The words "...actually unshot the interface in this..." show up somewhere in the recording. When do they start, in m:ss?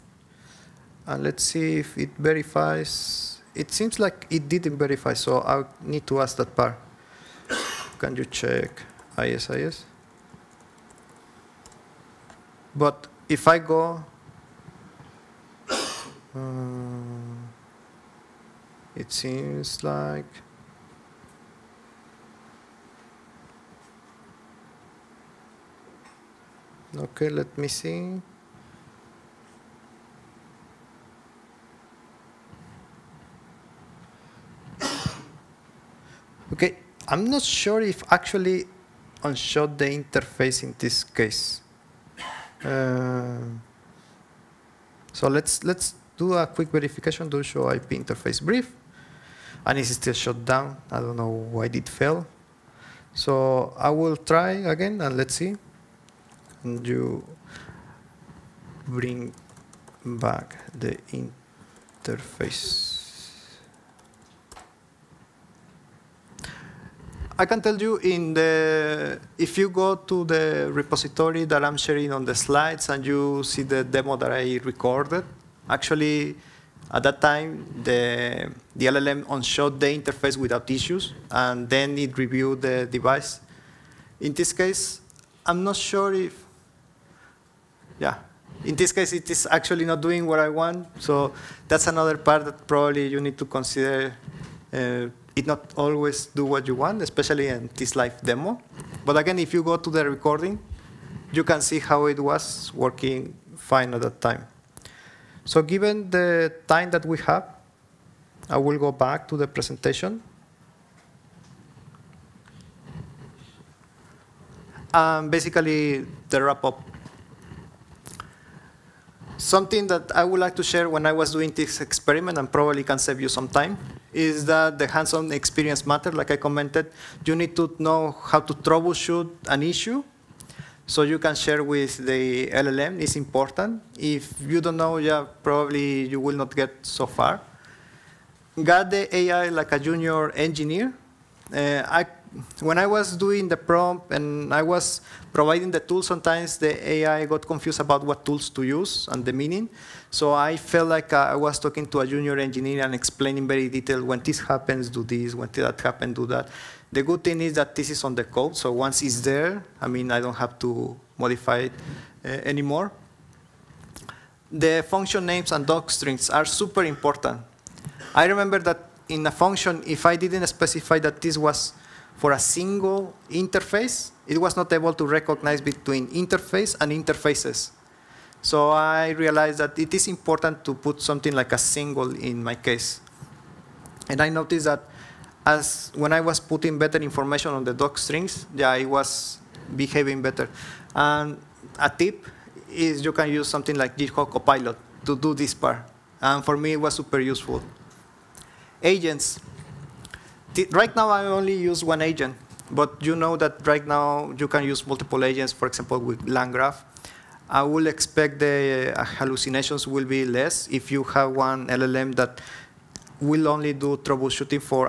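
0:38.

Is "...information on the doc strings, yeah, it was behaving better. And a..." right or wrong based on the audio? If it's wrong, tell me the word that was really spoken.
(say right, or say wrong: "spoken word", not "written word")
right.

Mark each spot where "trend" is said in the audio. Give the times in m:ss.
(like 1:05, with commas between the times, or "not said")
not said.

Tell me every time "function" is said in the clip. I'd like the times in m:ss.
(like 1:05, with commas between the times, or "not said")
2:44, 2:49.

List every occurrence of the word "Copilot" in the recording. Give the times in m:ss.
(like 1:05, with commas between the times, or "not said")
3:14.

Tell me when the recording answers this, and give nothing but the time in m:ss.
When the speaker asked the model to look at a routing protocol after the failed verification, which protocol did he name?
0:09.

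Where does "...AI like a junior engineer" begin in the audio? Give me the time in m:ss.
2:19.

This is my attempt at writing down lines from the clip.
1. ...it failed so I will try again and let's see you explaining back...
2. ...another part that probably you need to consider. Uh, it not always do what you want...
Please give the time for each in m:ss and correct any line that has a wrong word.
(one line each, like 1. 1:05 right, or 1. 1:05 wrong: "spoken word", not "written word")
1. 0:51 wrong: "bring", not "explaining"
2. 1:31 right.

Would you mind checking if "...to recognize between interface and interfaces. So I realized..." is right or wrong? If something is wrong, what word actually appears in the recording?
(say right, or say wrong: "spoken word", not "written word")
right.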